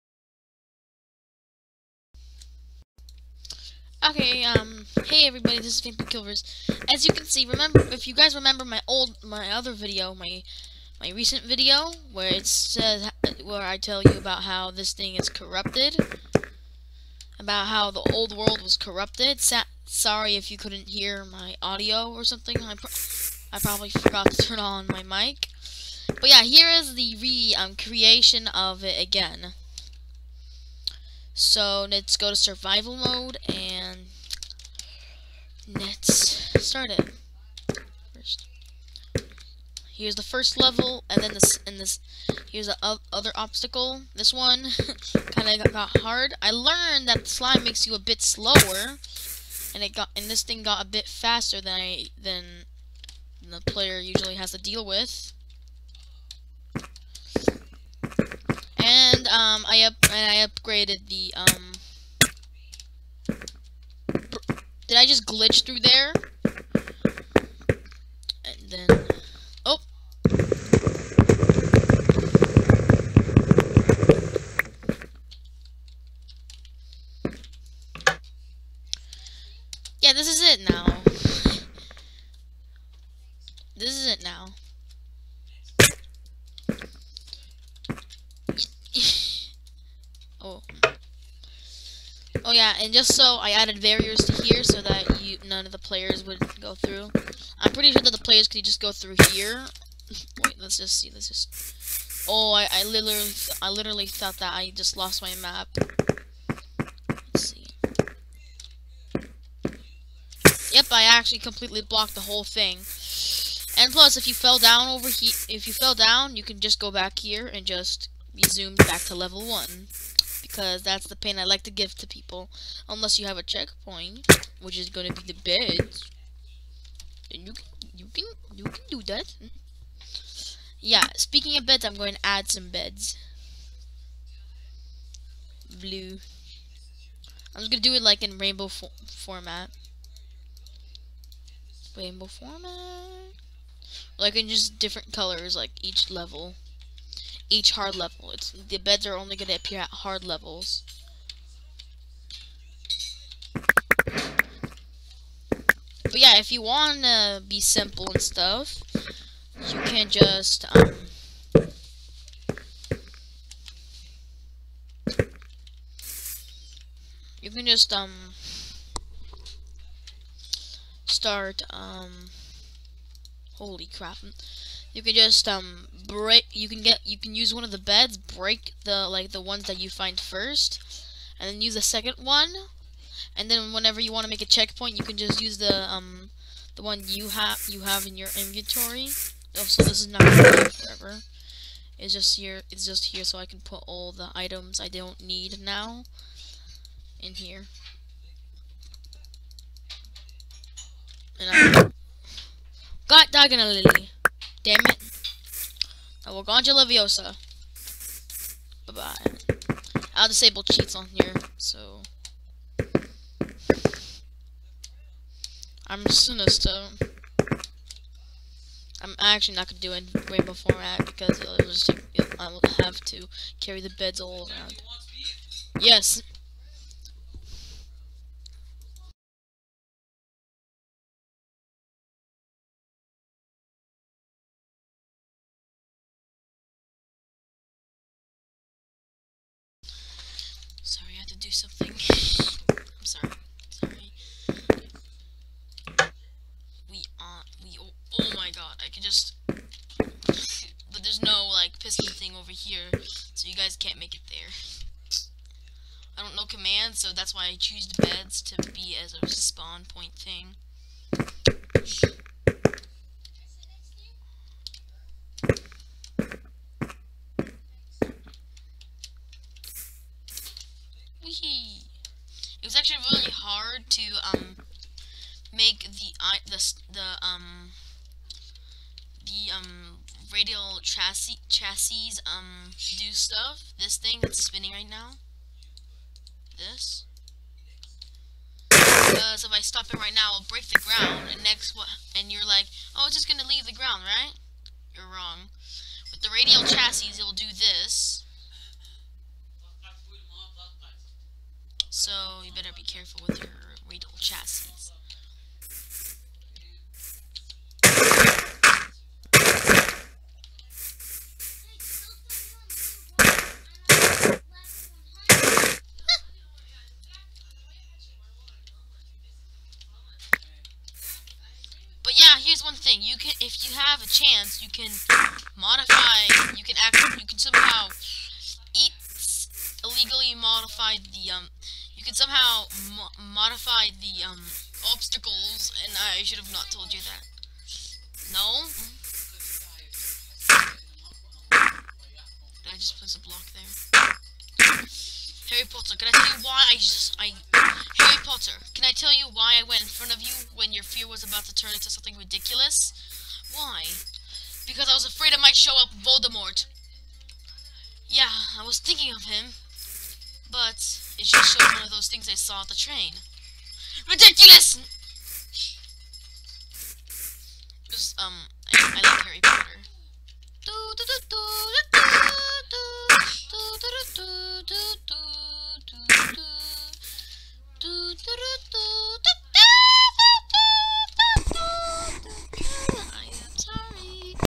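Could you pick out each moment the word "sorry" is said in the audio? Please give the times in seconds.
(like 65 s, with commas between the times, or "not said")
19 s, 240 s.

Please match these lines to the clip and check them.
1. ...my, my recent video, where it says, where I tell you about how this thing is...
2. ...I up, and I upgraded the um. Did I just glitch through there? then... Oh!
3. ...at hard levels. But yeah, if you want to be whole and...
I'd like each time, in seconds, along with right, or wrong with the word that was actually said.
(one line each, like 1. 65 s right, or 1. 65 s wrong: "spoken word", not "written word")
1. 10 s right
2. 59 s right
3. 149 s wrong: "simple", not "whole".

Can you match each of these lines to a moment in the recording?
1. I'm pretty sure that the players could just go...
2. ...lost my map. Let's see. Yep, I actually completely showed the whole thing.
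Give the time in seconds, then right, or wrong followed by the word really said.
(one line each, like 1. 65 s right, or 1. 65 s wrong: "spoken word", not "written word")
1. 97 s right
2. 104 s wrong: "blocked", not "showed".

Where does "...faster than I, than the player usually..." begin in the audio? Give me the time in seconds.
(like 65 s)
51 s.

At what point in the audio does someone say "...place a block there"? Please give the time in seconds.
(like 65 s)
342 s.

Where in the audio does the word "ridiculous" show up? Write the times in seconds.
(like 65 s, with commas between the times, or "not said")
352 s, 364 s.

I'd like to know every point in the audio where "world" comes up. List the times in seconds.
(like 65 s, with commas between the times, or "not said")
18 s.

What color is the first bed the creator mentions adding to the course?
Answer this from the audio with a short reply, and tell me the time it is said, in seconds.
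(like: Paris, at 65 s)
Blue, at 135 s.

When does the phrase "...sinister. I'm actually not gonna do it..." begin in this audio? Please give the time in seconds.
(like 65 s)
216 s.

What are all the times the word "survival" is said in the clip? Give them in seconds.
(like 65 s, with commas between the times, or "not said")
32 s.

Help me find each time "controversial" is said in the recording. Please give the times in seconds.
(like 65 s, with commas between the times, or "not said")
not said.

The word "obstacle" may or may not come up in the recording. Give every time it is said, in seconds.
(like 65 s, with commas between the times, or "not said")
43 s, 334 s.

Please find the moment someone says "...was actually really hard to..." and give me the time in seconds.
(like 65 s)
272 s.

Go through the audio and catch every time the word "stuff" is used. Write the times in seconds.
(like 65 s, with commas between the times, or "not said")
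158 s, 283 s.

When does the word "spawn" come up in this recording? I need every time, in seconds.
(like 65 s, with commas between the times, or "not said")
259 s.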